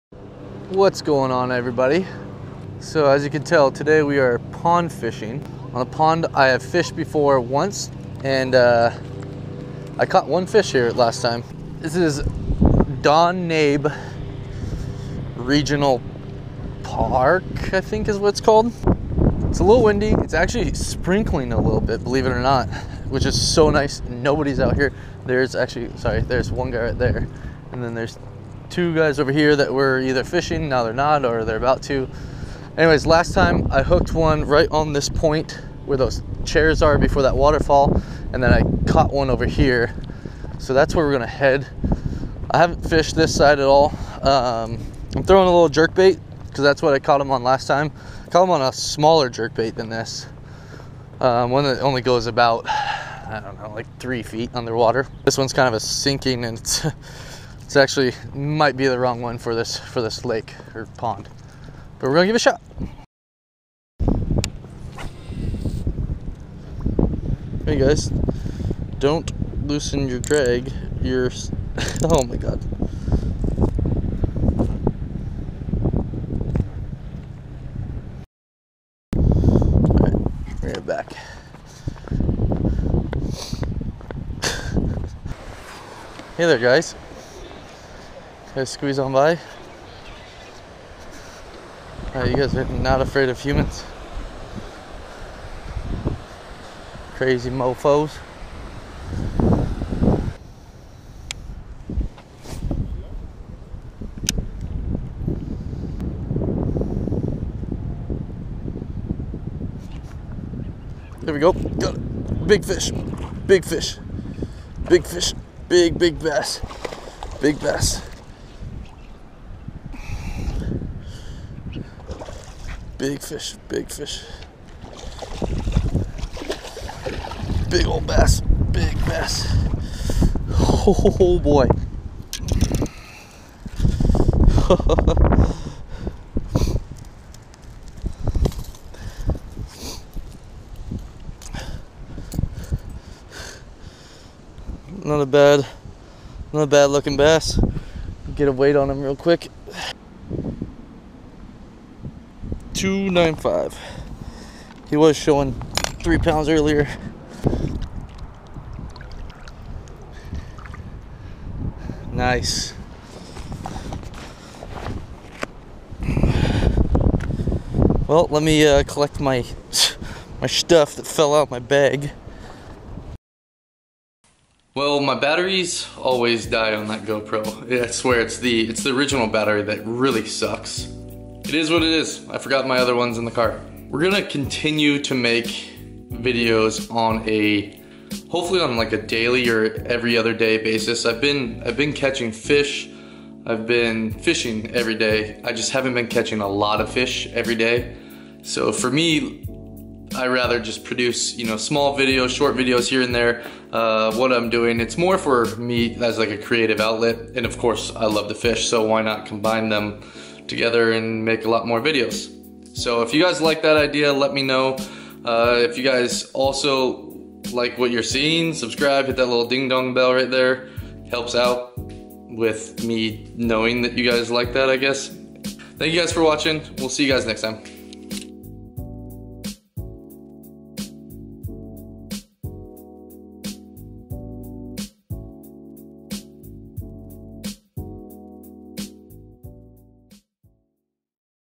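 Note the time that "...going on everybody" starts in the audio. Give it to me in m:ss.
0:01.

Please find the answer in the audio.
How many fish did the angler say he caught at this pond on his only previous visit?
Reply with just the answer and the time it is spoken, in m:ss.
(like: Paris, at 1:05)
1, at 0:10.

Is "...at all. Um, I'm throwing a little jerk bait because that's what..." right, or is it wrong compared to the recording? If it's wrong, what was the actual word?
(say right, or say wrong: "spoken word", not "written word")
right.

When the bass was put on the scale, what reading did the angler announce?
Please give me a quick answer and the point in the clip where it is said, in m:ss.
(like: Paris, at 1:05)
2.95, at 2:32.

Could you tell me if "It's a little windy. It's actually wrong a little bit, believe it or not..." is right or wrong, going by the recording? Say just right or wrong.
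wrong.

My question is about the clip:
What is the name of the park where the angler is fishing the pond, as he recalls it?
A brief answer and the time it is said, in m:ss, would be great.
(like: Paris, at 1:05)
Don Nabe Regional Park, at 0:13.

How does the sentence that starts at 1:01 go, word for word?
But we're gonna give it a shot.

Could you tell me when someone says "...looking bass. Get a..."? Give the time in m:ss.
2:26.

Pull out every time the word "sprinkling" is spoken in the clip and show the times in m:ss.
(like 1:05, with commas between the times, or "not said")
0:20.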